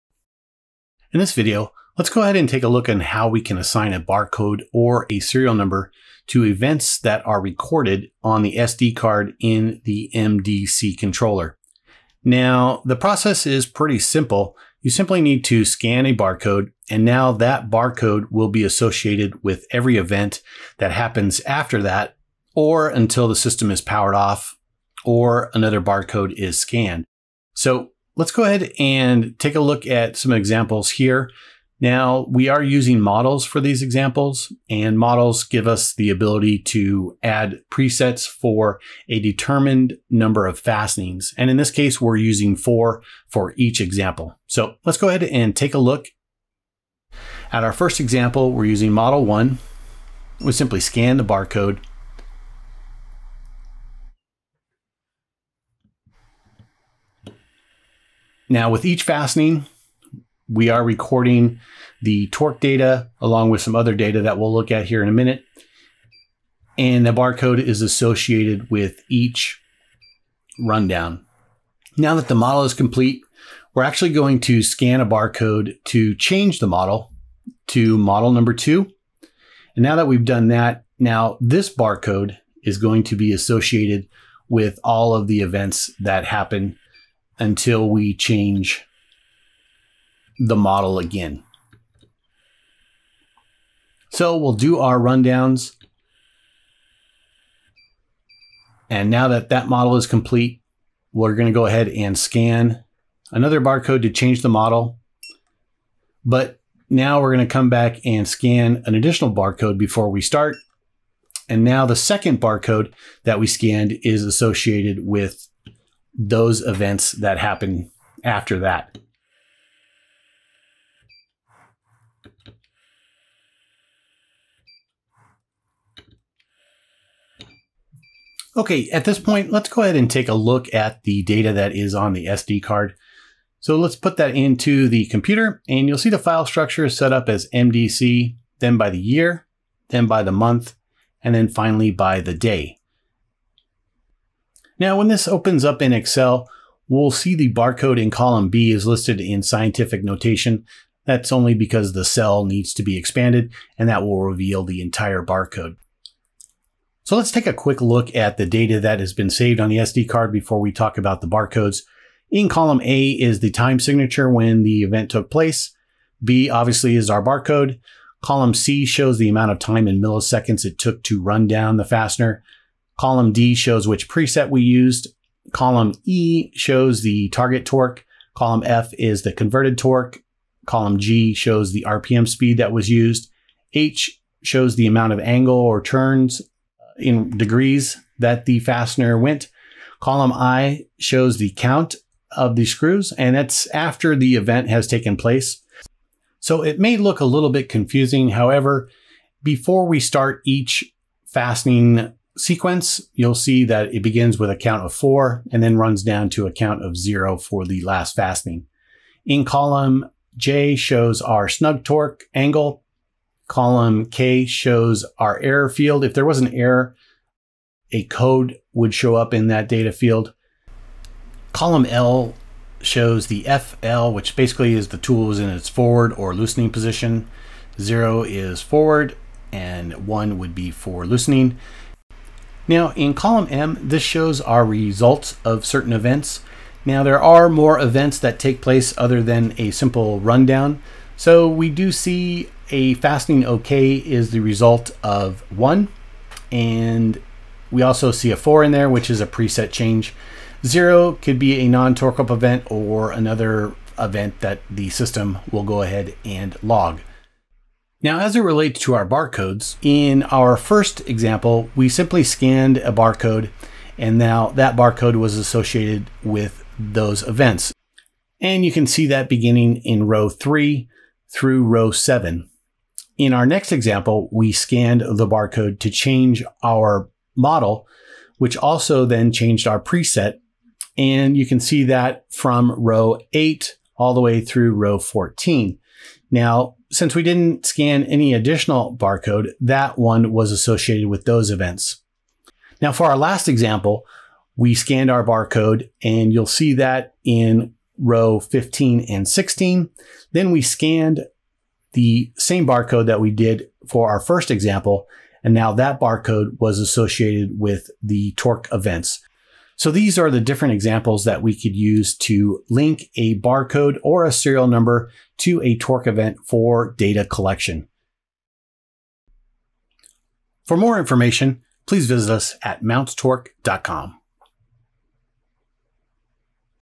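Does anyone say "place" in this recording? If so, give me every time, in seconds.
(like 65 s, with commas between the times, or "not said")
165 s, 195 s, 238 s.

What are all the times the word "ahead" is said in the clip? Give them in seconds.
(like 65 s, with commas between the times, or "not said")
2 s, 28 s, 45 s, 101 s, 129 s, 255 s.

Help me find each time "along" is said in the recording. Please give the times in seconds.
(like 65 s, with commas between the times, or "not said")
63 s.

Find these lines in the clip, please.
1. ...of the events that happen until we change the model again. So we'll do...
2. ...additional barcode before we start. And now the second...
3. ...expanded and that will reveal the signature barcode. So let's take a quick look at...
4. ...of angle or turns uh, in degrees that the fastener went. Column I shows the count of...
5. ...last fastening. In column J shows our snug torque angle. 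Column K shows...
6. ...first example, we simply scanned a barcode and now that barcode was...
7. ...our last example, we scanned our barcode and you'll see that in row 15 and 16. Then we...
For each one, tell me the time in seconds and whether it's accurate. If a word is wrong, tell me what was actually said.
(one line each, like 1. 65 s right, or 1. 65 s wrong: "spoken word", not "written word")
1. 85 s right
2. 108 s right
3. 152 s wrong: "entire", not "signature"
4. 185 s right
5. 207 s right
6. 260 s right
7. 293 s right.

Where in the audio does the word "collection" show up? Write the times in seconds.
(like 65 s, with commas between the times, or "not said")
317 s.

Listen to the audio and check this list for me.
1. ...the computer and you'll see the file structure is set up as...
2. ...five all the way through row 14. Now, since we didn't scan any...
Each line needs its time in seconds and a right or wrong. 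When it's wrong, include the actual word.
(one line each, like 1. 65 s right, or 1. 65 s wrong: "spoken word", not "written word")
1. 134 s right
2. 283 s wrong: "eight", not "five".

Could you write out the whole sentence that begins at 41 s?
And in this case, we're using four for each example.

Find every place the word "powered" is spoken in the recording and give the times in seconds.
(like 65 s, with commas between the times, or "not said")
23 s.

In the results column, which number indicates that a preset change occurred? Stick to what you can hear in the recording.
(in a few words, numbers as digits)
4.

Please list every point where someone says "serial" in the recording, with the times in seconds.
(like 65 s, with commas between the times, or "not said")
5 s, 314 s.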